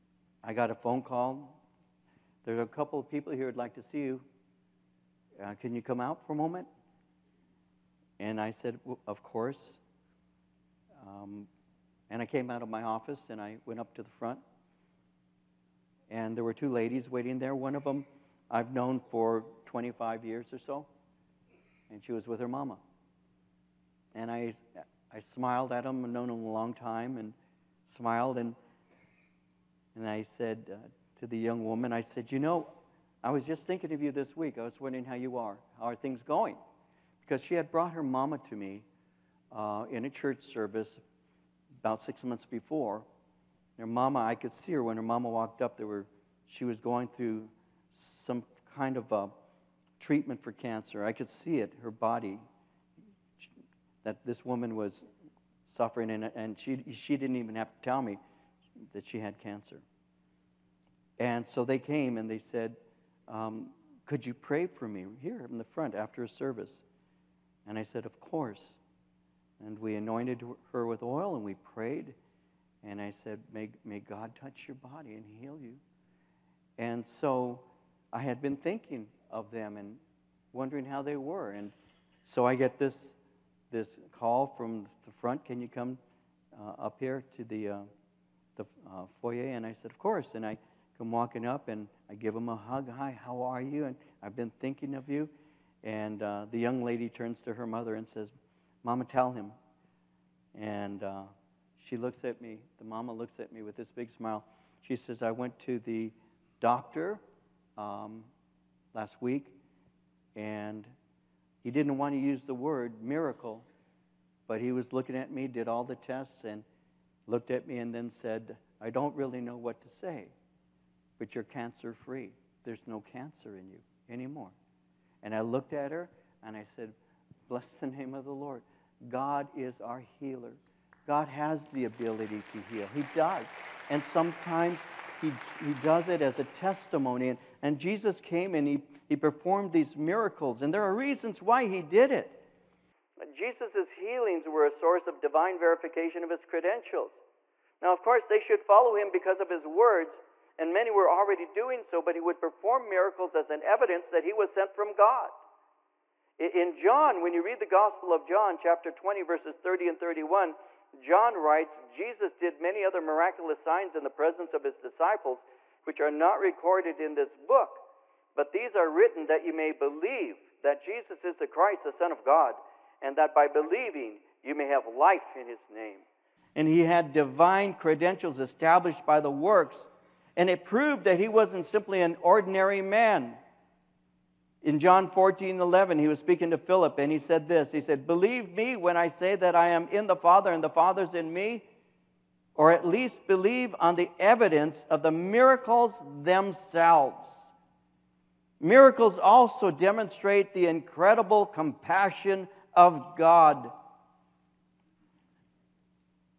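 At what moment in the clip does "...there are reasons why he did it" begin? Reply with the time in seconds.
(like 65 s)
140 s.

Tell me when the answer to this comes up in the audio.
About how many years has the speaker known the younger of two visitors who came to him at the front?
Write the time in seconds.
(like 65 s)
19 s.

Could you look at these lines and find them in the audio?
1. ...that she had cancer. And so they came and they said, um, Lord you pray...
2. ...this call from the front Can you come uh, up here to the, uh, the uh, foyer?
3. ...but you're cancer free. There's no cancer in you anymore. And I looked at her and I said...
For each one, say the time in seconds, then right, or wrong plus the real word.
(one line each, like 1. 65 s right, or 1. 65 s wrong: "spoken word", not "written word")
1. 58 s wrong: "Could", not "Lord"
2. 83 s right
3. 121 s right.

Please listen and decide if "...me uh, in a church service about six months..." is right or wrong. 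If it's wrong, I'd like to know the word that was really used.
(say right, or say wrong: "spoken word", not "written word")
right.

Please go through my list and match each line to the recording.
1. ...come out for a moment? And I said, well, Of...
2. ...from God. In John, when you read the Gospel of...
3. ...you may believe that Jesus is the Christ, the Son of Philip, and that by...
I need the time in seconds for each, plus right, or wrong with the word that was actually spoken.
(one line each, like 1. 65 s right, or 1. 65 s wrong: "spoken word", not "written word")
1. 5 s right
2. 154 s right
3. 169 s wrong: "God", not "Philip".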